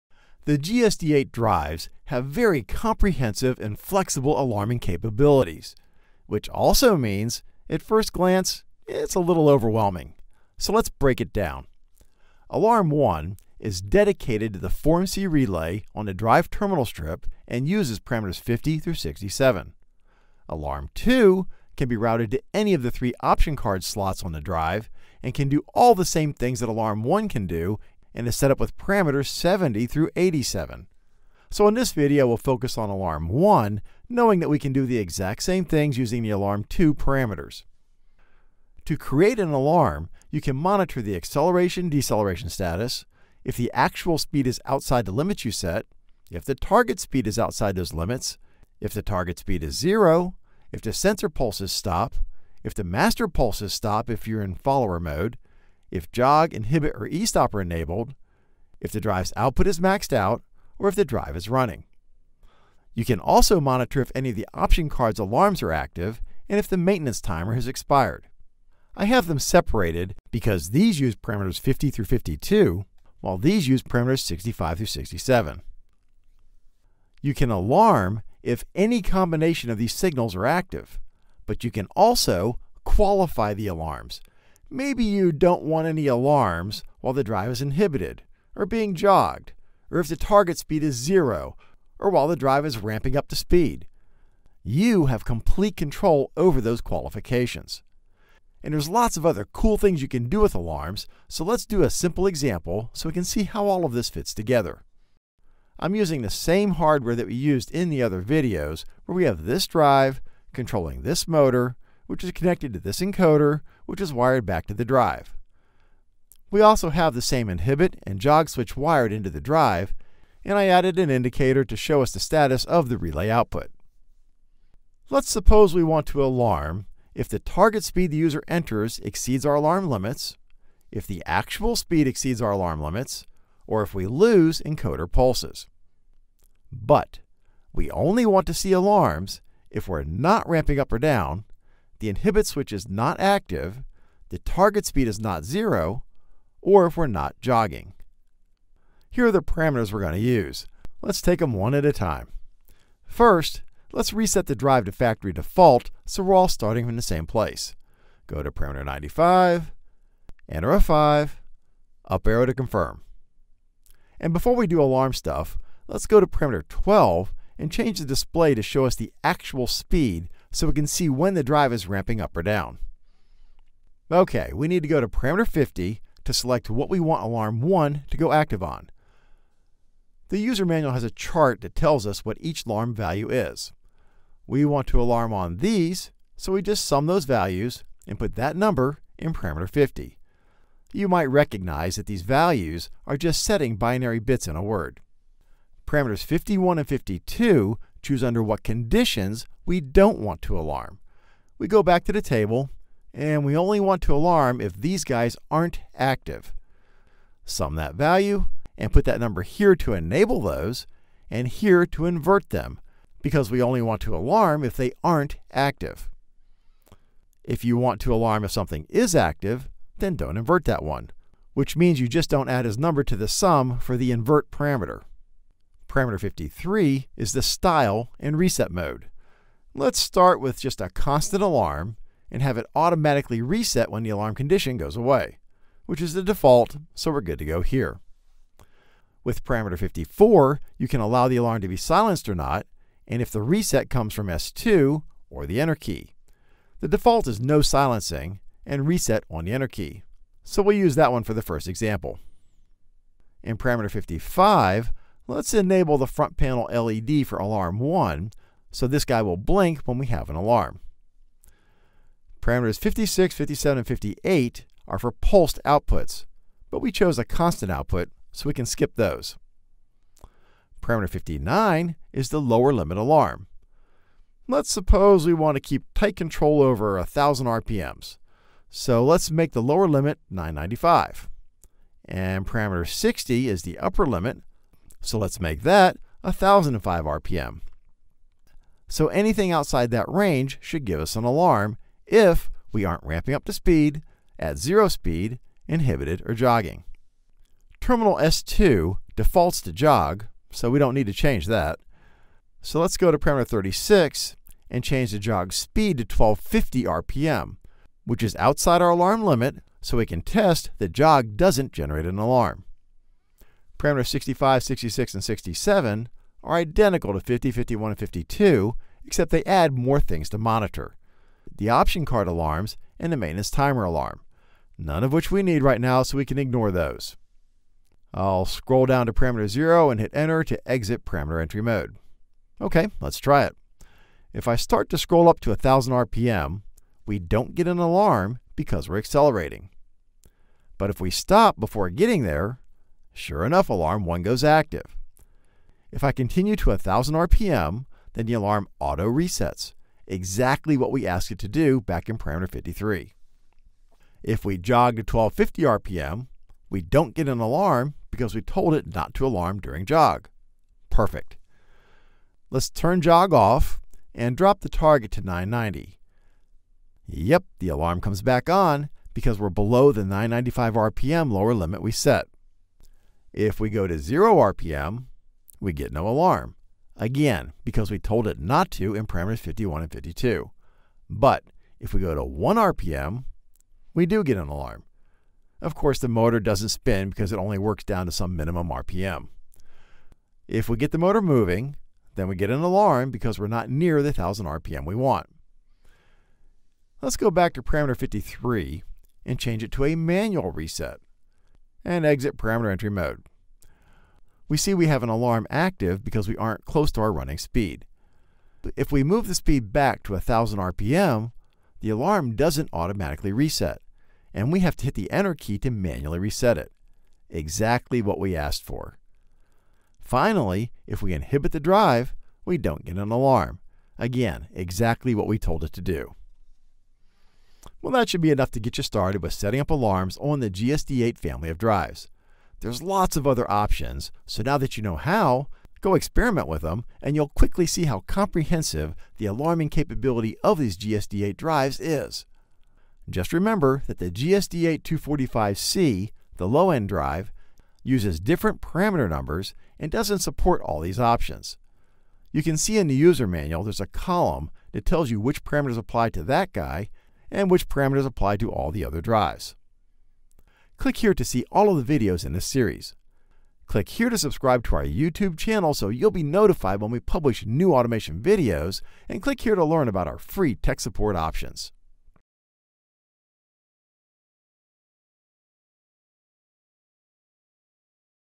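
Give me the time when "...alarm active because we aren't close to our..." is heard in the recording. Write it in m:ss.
6:45.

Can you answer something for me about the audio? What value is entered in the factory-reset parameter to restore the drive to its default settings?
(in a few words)
5.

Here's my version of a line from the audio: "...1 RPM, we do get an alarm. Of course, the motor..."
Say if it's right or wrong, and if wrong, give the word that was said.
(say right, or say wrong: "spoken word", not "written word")
right.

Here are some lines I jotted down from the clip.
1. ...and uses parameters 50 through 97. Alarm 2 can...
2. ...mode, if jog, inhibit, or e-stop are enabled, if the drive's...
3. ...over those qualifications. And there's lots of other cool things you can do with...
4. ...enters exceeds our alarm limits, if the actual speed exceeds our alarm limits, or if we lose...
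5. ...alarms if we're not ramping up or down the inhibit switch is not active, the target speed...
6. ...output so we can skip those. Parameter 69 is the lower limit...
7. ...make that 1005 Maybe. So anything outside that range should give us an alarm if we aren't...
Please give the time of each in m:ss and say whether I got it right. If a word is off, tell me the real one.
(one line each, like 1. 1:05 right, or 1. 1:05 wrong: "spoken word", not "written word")
1. 0:17 wrong: "67", not "97"
2. 0:54 right
3. 1:36 right
4. 2:08 right
5. 2:18 right
6. 4:27 wrong: "59", not "69"
7. 4:45 wrong: "RPM", not "Maybe".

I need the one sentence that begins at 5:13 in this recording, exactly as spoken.
Parameters 65, 66, and 67 are identical to 50, 51, and 52, except they add more things to monitor.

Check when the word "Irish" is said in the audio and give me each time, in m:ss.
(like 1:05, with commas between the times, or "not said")
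not said.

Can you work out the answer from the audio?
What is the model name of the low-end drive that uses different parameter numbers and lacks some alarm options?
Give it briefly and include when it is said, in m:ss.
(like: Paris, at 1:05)
GSD8-240-5C, at 7:24.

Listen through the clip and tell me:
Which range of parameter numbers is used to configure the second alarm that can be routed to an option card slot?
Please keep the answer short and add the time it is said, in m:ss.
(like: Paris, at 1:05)
70 through 87, at 0:29.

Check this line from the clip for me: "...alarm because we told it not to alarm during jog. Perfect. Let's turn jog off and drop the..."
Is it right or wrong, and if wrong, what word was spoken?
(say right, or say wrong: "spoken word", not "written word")
right.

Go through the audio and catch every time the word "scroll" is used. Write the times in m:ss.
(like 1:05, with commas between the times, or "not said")
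5:28, 5:34.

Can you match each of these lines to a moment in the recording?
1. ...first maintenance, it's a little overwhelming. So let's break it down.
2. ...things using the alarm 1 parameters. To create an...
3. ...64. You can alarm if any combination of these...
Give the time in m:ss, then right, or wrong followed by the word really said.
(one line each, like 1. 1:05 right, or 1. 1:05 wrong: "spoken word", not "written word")
1. 0:07 wrong: "glance", not "maintenance"
2. 0:35 wrong: "2", not "1"
3. 1:14 wrong: "67", not "64".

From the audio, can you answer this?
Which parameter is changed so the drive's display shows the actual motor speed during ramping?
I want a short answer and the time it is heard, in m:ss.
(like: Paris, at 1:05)
12, at 2:46.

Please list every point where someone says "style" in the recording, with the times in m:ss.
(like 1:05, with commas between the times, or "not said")
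3:47.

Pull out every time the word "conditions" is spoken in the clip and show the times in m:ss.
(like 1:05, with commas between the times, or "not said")
3:18, 3:54.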